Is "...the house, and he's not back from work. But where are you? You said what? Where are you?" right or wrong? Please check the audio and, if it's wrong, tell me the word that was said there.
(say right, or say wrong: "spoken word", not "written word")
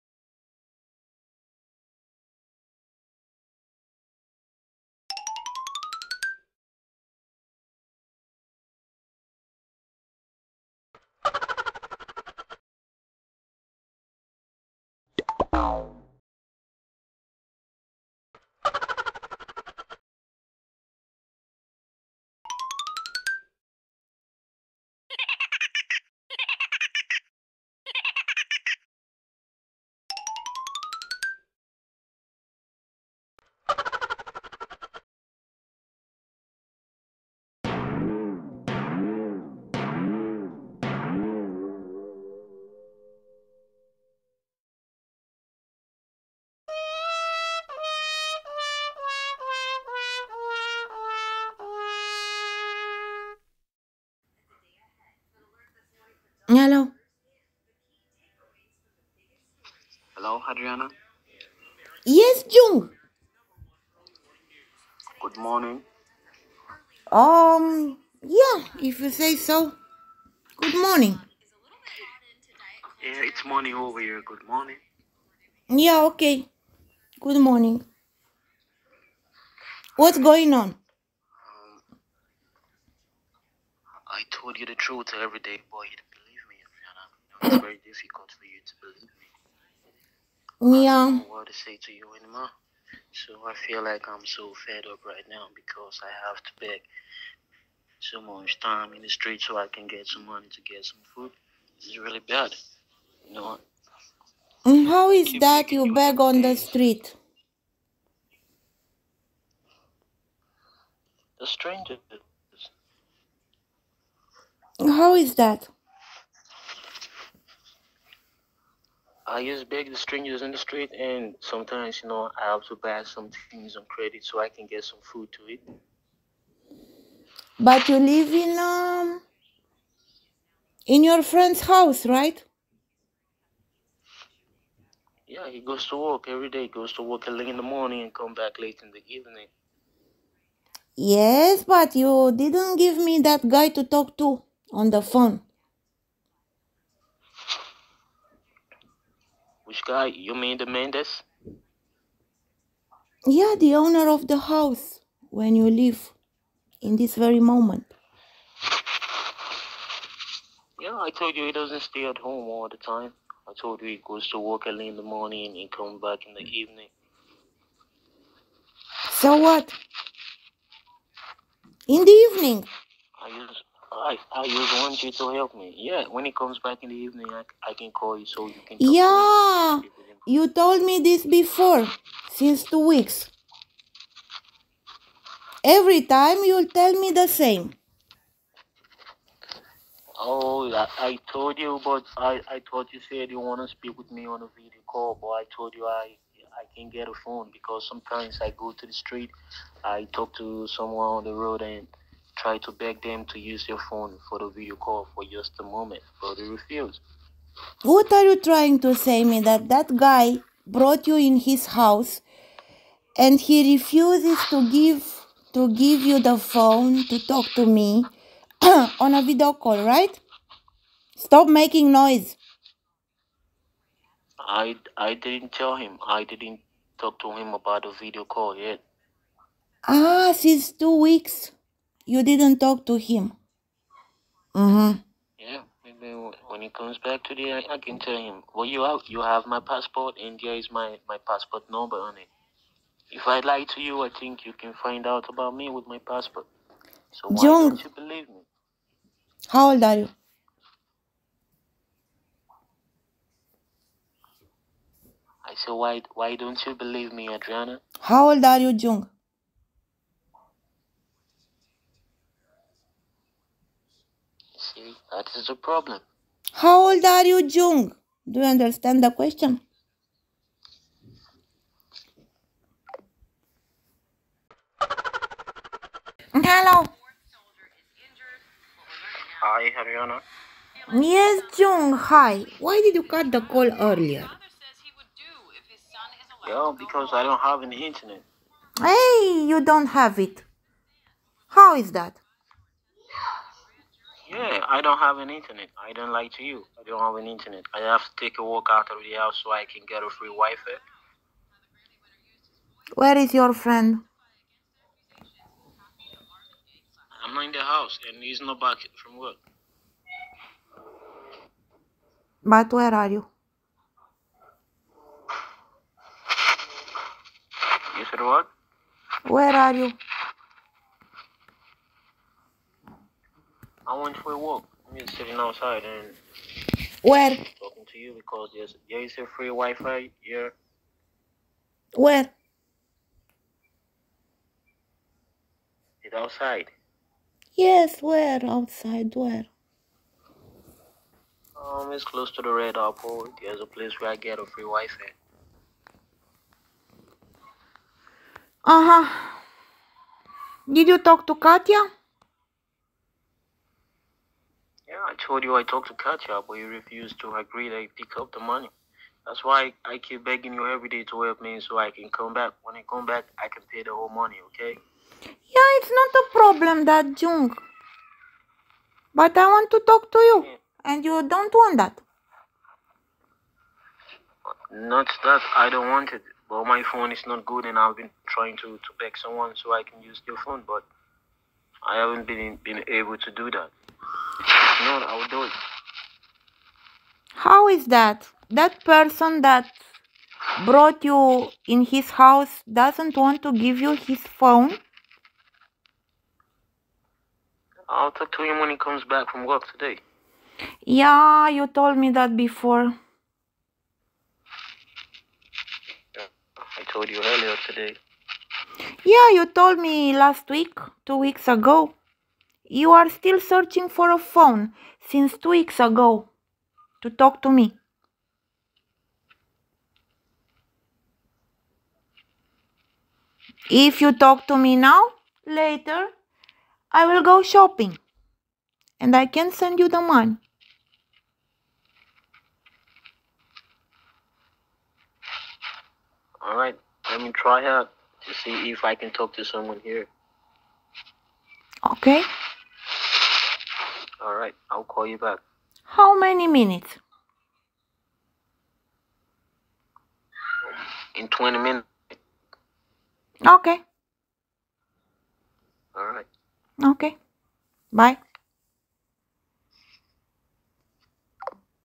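right.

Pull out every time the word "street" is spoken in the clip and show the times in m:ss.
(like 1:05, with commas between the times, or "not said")
1:39, 1:46, 2:00, 3:18.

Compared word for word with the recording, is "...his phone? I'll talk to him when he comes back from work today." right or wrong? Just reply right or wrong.
right.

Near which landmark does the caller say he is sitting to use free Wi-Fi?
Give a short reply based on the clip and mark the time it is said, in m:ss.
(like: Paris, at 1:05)
Red Apple, at 5:42.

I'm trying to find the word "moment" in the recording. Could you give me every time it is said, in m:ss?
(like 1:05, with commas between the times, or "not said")
2:37, 3:25.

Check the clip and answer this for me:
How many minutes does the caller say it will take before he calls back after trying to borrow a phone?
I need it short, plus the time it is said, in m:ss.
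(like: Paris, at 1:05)
20, at 7:31.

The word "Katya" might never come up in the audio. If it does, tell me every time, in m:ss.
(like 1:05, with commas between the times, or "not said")
5:51, 5:55.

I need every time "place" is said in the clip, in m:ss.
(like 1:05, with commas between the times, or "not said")
5:43.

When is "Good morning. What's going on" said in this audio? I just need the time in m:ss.
1:17.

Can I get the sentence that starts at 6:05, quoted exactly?
Yeah, it's not a problem that Jung.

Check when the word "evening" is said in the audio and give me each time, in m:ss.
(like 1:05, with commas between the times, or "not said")
2:19, 2:46, 2:52, 2:56.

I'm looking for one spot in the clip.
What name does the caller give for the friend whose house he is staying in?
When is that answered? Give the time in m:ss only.
2:30.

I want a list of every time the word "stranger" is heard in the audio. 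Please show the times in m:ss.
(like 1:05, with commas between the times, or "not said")
1:51, 1:59.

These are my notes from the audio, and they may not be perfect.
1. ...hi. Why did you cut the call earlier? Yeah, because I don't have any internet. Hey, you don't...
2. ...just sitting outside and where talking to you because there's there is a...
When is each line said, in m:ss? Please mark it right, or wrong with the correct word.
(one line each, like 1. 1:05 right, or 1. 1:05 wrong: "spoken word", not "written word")
1. 4:41 right
2. 5:24 right.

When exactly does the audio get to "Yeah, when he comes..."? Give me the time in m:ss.
2:55.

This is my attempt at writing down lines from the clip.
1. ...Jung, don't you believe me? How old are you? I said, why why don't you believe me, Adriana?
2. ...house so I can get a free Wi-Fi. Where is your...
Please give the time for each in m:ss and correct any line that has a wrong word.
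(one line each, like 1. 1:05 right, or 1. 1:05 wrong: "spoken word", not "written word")
1. 4:07 right
2. 4:59 right.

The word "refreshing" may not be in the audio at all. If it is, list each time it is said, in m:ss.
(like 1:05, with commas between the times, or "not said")
not said.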